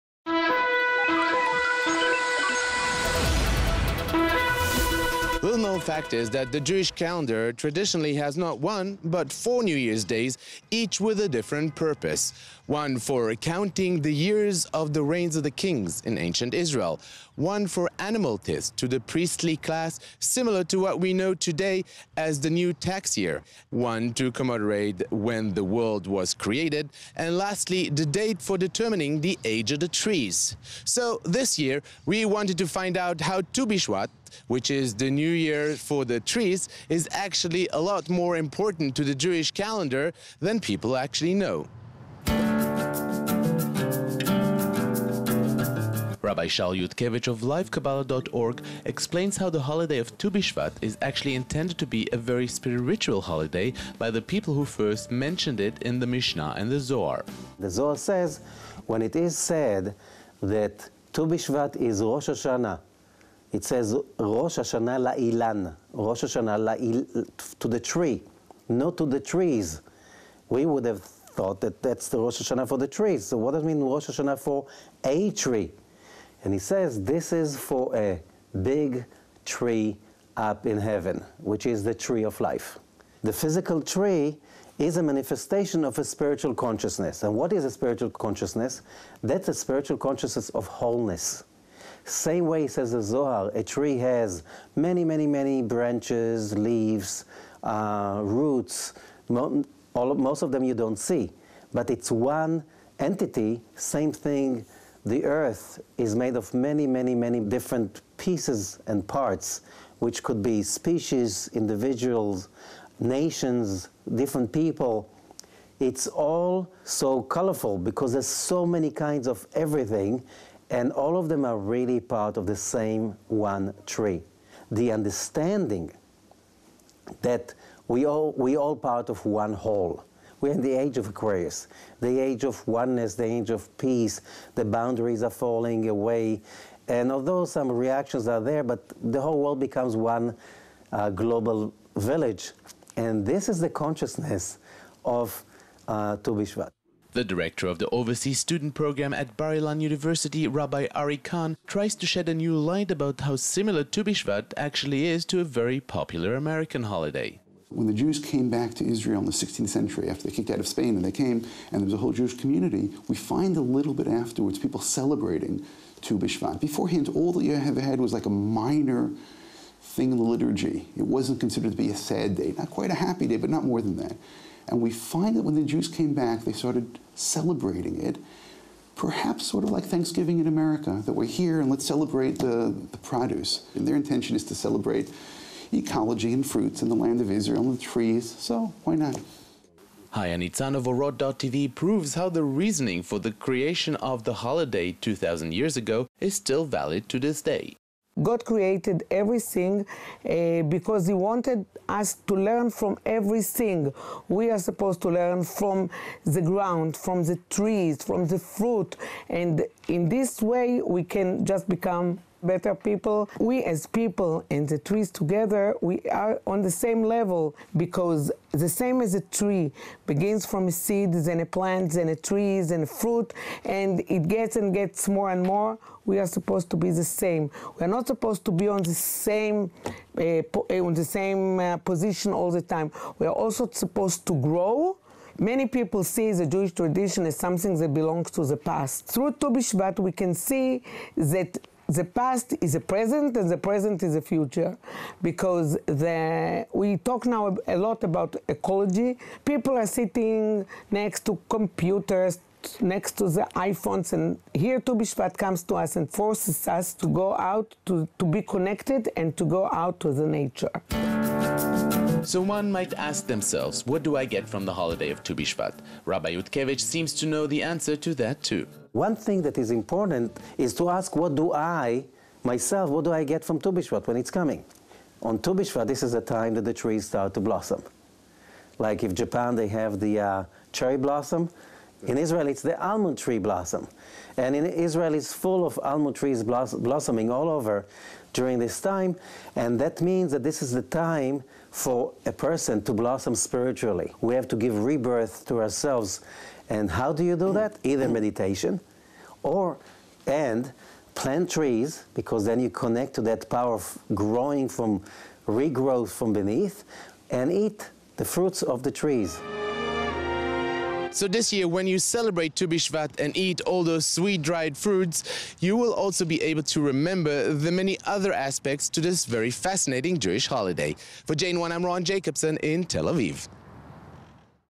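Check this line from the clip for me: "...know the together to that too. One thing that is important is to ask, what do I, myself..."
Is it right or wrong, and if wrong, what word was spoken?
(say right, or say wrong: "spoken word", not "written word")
wrong: "answer", not "together".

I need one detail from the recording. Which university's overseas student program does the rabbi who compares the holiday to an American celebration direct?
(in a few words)
Bar Ilan University.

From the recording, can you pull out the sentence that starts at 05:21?
For JN1, I'm Ron Jacobsohn in Tel Aviv.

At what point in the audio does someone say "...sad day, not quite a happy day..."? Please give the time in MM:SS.
02:51.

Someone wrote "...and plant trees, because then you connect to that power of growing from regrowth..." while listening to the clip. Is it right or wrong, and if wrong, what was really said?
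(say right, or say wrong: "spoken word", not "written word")
right.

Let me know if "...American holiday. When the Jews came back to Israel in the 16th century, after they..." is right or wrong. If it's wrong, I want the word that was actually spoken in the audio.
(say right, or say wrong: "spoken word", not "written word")
right.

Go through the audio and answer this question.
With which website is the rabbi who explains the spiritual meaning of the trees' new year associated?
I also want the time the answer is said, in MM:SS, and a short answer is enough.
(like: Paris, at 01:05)
LiveKabbalah.org, at 00:47.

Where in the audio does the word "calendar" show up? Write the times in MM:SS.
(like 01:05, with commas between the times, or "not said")
00:06, 00:39.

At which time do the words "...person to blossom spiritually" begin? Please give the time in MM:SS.
04:52.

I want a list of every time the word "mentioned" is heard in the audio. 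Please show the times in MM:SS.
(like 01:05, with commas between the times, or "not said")
00:55.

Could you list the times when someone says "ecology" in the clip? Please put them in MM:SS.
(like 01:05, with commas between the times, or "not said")
03:05, 04:08.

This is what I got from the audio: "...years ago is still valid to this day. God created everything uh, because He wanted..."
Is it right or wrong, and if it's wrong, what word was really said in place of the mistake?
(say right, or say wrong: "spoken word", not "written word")
right.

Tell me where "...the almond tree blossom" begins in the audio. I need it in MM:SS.
04:42.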